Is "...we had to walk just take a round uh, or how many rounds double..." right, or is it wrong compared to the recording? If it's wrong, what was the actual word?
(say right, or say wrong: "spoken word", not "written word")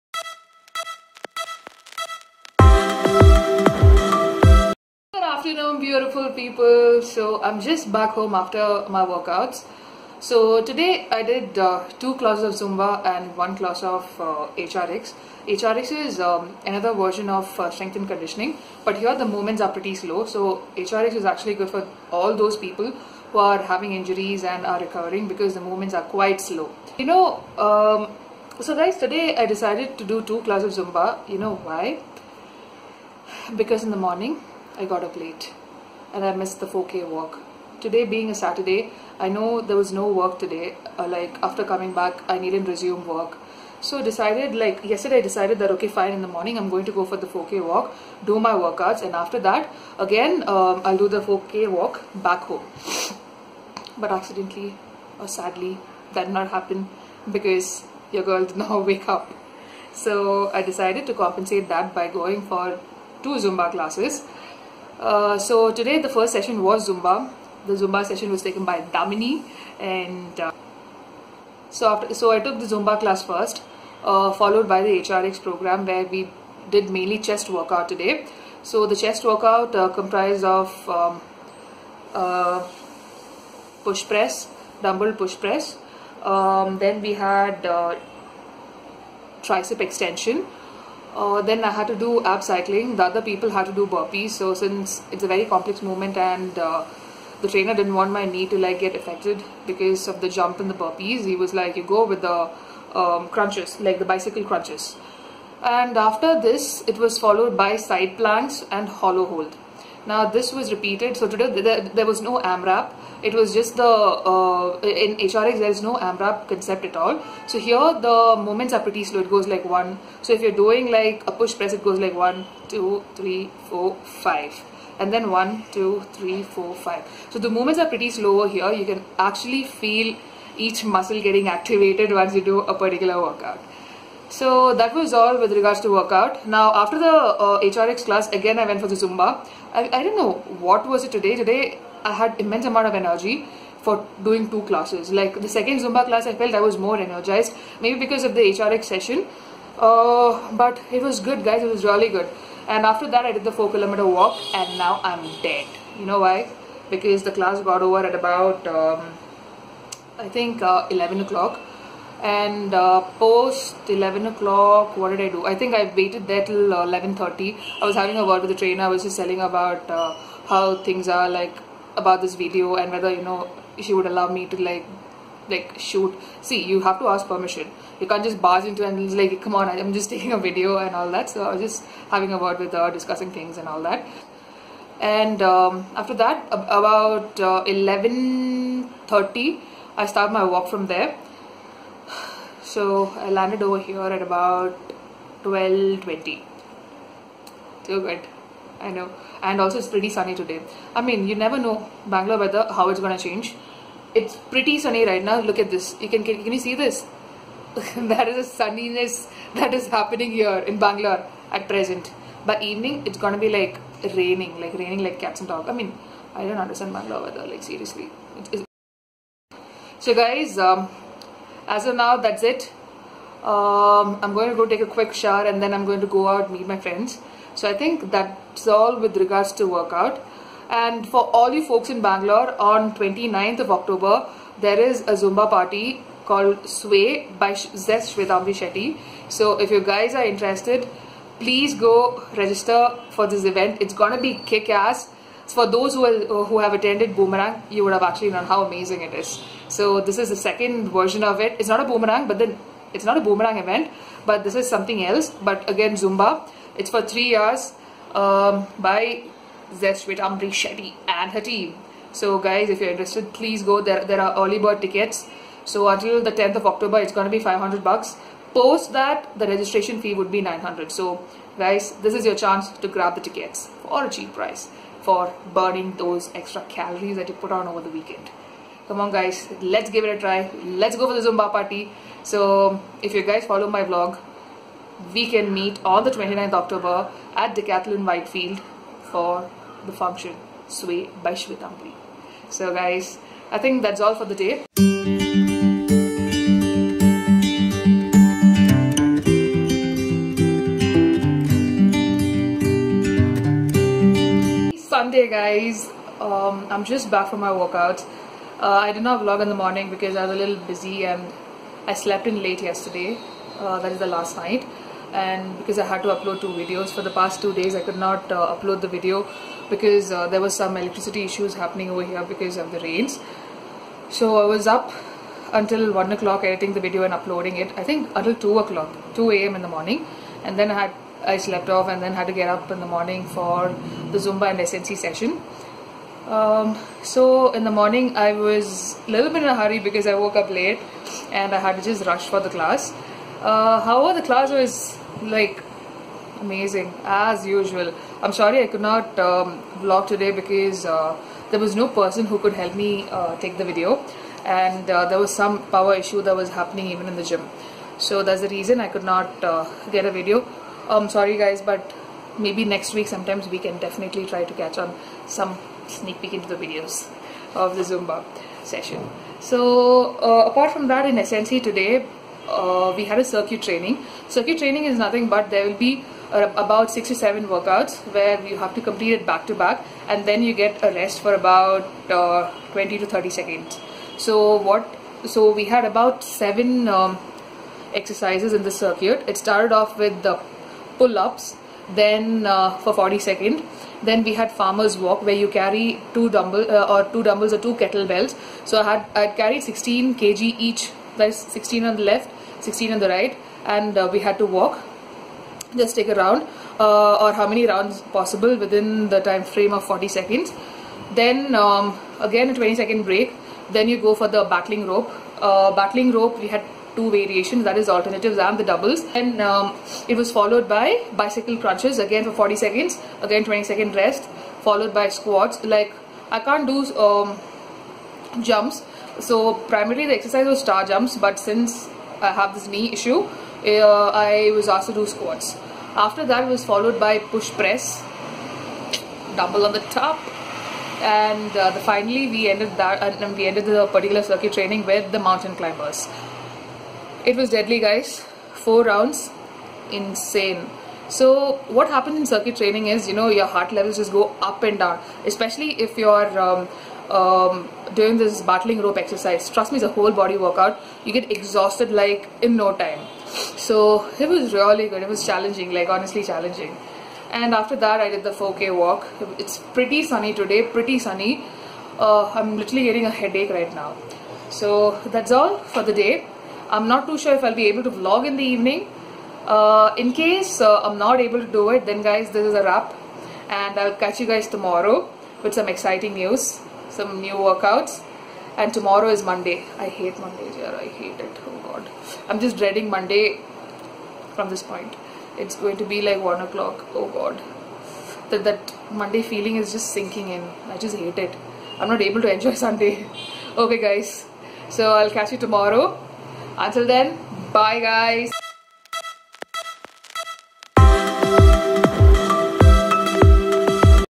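wrong: "possible", not "double".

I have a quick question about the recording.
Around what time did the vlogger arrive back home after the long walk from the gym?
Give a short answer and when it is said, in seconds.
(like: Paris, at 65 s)
12:20, at 195 s.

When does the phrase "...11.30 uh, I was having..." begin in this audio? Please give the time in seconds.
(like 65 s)
166 s.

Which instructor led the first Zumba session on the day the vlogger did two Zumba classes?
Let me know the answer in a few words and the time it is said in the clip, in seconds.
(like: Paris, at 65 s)
Damini, at 68 s.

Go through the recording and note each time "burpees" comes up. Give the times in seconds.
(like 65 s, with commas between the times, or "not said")
93 s, 100 s.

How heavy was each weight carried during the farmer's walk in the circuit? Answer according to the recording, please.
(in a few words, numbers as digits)
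16 kg.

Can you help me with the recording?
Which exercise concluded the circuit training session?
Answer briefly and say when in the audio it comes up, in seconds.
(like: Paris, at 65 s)
Mountain climbers, at 445 s.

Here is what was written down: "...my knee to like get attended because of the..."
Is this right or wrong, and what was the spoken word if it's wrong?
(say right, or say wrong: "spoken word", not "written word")
wrong: "affected", not "attended".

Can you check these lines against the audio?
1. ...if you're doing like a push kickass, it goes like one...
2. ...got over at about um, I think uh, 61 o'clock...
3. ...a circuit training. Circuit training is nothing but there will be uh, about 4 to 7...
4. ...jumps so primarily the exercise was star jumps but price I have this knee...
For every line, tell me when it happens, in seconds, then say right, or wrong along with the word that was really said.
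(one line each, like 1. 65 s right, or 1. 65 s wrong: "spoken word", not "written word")
1. 120 s wrong: "press", not "kickass"
2. 157 s wrong: "11", not "61"
3. 373 s wrong: "6", not "4"
4. 428 s wrong: "since", not "price".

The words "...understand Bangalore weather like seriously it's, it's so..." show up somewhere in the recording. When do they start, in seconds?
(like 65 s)
216 s.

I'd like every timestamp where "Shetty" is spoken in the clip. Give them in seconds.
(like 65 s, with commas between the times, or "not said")
238 s, 260 s.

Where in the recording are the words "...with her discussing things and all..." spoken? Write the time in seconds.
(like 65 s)
182 s.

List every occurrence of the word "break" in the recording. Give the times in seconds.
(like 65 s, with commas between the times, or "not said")
413 s.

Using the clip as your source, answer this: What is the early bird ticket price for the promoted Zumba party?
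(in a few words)
500 bucks.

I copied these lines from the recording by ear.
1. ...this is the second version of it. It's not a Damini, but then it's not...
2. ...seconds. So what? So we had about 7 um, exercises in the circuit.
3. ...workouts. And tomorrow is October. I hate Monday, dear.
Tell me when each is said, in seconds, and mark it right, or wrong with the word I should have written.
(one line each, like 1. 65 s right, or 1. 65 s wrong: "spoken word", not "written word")
1. 250 s wrong: "Boomerang", not "Damini"
2. 383 s right
3. 487 s wrong: "Monday", not "October".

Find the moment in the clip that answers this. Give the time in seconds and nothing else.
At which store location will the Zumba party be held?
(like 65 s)
287 s.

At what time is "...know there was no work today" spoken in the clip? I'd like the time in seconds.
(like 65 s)
39 s.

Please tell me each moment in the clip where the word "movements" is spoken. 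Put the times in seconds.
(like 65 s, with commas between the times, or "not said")
19 s, 25 s, 95 s, 127 s.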